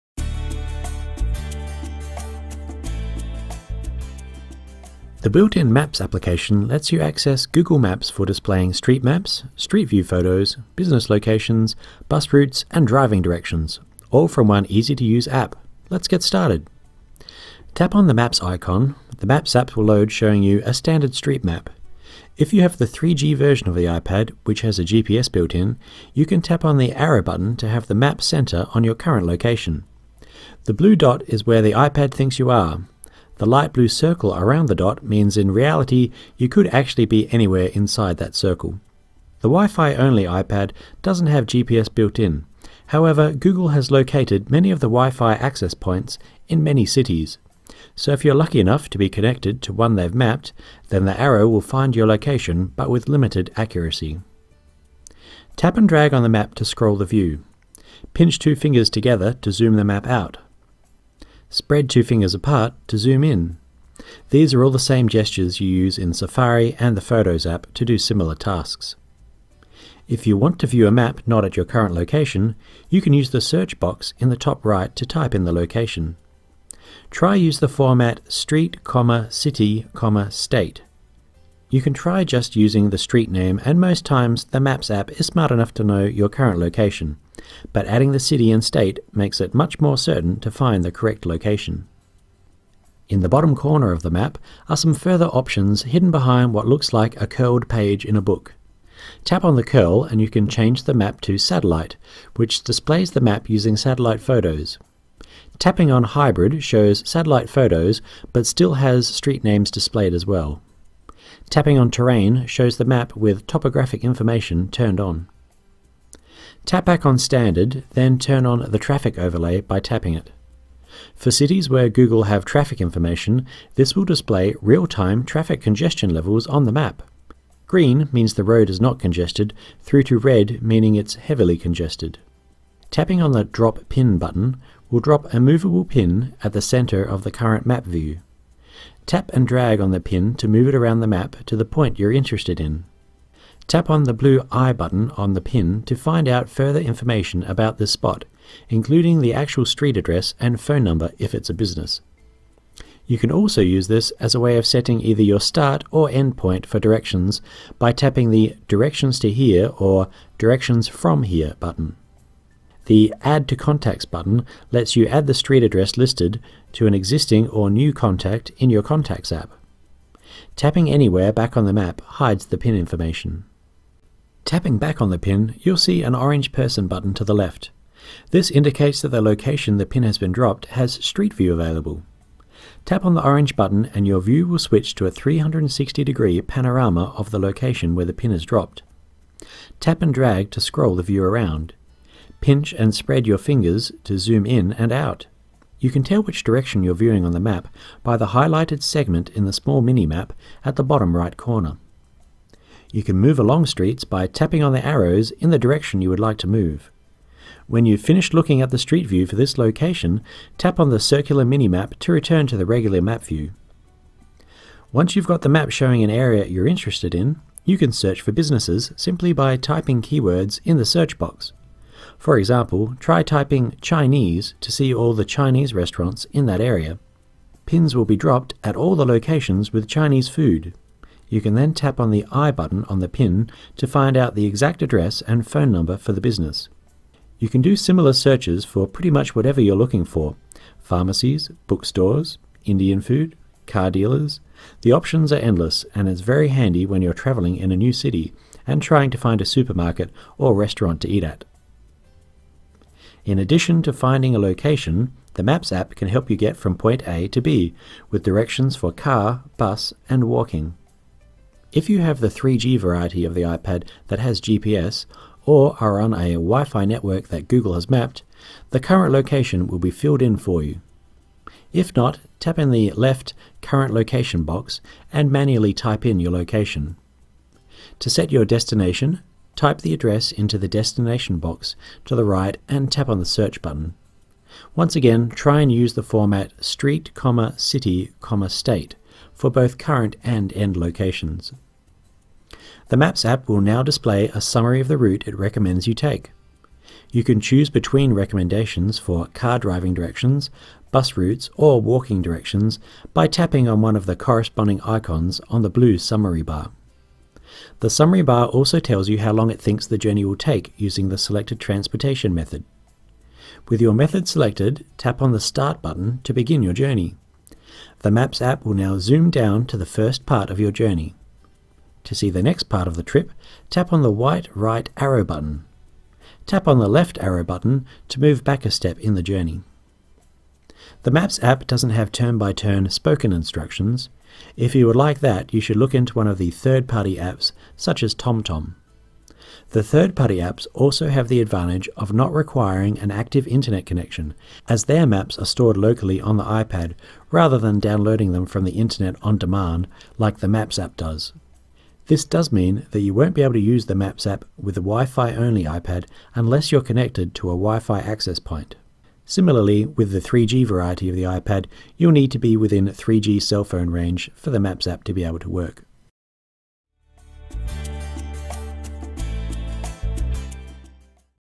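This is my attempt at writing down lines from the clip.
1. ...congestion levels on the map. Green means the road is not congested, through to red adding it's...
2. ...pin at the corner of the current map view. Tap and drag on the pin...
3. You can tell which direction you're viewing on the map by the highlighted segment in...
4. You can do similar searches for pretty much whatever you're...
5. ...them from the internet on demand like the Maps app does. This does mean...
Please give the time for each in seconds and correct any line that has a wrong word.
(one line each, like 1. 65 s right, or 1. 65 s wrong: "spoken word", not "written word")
1. 125 s wrong: "meaning", not "adding"
2. 135 s wrong: "center", not "corner"
3. 195 s right
4. 237 s right
5. 348 s right.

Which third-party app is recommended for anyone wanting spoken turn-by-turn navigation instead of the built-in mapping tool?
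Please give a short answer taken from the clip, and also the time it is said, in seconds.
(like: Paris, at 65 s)
TomTom, at 338 s.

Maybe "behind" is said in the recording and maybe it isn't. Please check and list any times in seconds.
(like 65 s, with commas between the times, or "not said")
96 s.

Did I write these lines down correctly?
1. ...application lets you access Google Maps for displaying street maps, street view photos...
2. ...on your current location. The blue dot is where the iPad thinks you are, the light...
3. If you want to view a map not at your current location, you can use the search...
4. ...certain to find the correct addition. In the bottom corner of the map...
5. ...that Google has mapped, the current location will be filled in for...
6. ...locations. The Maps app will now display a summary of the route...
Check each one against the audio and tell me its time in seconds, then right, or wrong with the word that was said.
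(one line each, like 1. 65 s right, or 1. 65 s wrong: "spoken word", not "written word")
1. 6 s right
2. 28 s right
3. 70 s right
4. 89 s wrong: "location", not "addition"
5. 267 s right
6. 290 s right.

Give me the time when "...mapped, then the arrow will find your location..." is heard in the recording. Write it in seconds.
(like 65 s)
50 s.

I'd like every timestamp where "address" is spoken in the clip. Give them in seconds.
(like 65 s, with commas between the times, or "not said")
149 s, 165 s, 234 s, 279 s.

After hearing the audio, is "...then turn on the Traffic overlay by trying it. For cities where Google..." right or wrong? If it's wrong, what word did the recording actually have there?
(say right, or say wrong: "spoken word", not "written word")
wrong: "tapping", not "trying".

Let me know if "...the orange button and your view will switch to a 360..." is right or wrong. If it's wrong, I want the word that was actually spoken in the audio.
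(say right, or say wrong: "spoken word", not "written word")
right.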